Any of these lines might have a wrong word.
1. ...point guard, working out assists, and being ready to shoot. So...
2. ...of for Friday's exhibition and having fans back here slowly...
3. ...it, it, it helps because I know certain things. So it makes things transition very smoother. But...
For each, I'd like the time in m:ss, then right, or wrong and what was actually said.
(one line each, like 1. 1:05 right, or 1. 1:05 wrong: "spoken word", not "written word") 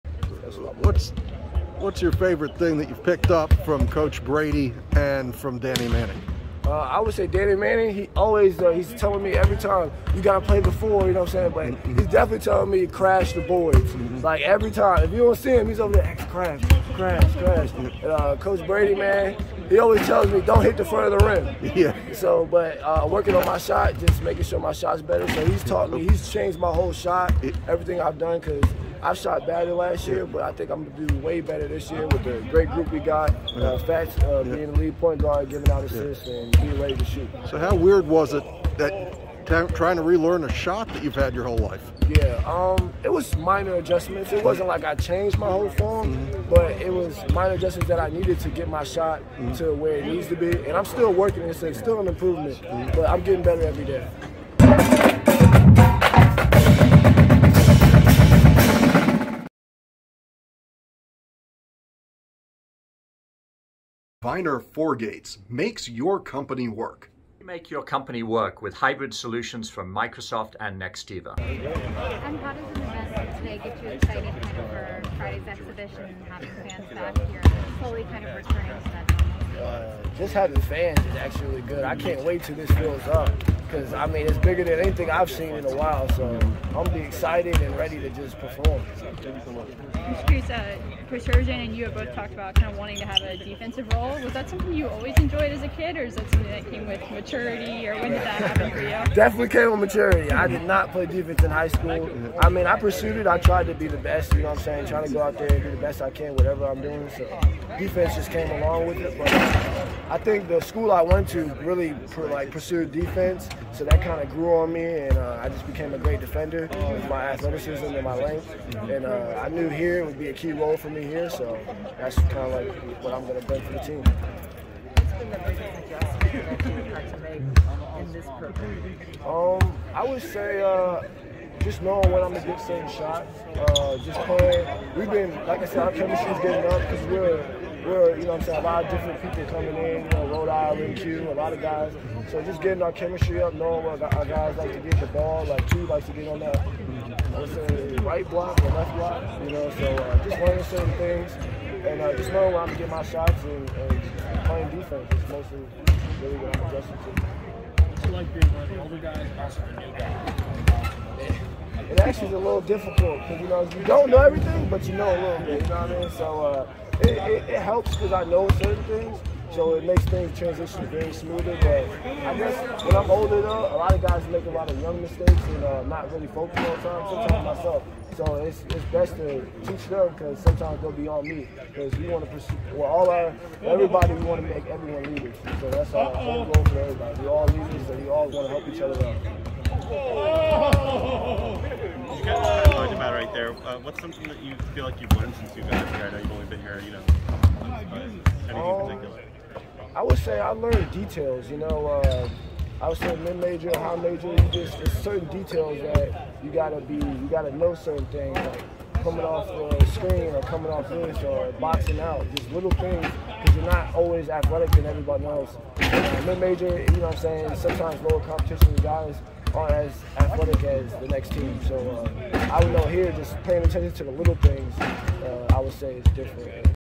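1. 0:34 wrong: "giving", not "working"
2. 1:14 right
3. 2:47 right.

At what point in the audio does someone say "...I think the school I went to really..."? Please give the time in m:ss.
1:50.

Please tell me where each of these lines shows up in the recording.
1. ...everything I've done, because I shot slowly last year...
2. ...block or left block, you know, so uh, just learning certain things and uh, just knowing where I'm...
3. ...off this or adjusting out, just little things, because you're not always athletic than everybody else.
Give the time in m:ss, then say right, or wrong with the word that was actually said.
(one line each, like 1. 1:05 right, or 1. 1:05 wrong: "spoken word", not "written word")
1. 0:27 wrong: "badly", not "slowly"
2. 2:28 right
3. 3:30 wrong: "boxing", not "adjusting".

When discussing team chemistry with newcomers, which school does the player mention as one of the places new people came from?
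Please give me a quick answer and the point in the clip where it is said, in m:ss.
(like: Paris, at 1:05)
Rhode Island, at 2:20.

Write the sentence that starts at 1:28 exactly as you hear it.
I'm just curious, uh, Petrosian and you have both talked about kind of wanting to have a defensive role.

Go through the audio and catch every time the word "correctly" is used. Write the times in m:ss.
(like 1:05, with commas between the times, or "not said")
not said.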